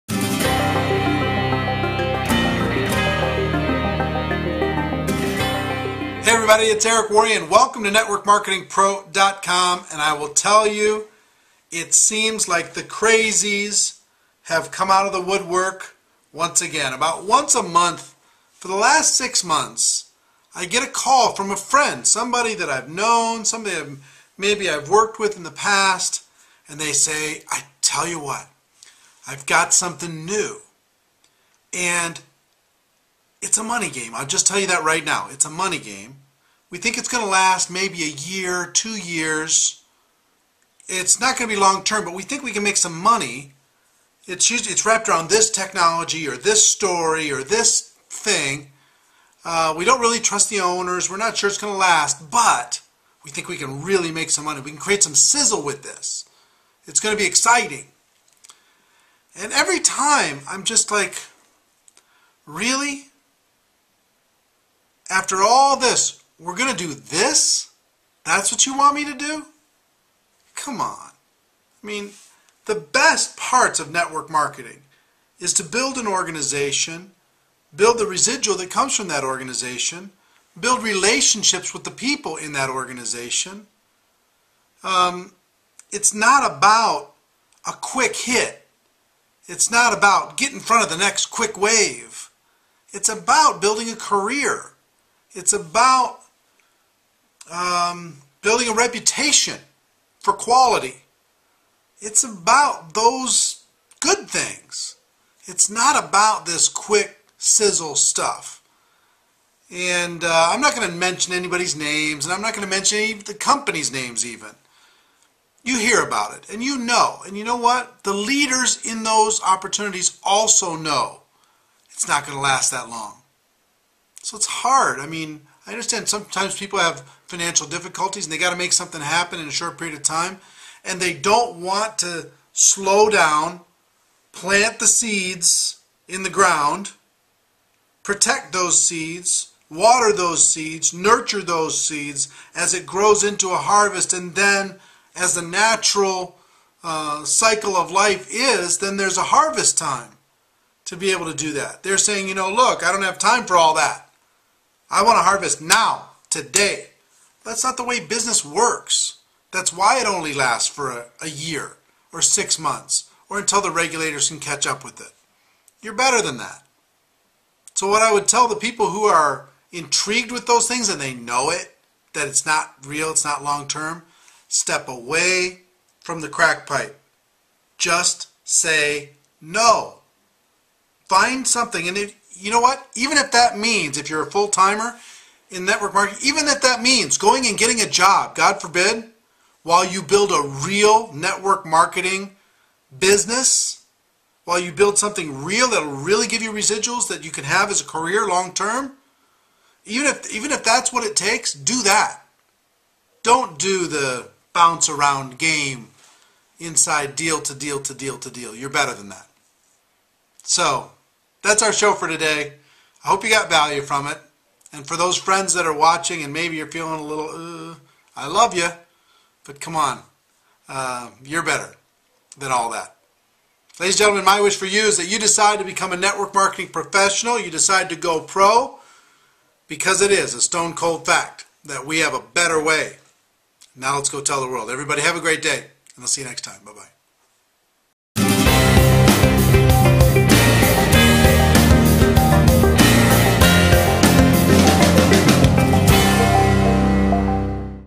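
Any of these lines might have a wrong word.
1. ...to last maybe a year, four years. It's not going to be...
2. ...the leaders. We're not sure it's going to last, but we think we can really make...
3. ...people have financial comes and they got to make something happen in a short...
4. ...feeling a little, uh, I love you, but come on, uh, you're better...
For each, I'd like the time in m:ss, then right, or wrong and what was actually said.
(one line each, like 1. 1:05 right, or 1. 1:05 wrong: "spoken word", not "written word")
1. 0:37 wrong: "two", not "four"
2. 0:50 wrong: "owners", not "leaders"
3. 2:06 wrong: "difficulties", not "comes"
4. 3:36 right.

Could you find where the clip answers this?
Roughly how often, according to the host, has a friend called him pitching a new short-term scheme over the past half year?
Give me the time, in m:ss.
0:17.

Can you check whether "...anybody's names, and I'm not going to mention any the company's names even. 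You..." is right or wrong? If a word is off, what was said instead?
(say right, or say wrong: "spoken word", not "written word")
right.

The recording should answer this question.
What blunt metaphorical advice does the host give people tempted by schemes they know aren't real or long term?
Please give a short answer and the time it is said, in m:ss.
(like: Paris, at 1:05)
Step away from the crack pipe, at 2:54.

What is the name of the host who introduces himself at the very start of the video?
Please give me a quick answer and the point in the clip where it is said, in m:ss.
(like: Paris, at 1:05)
Eric Worre, at 0:06.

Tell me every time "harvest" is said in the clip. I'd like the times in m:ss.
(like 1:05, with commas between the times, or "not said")
2:23, 2:29, 2:35.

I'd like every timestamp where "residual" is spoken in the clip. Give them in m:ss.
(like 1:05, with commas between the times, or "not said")
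1:18, 3:16.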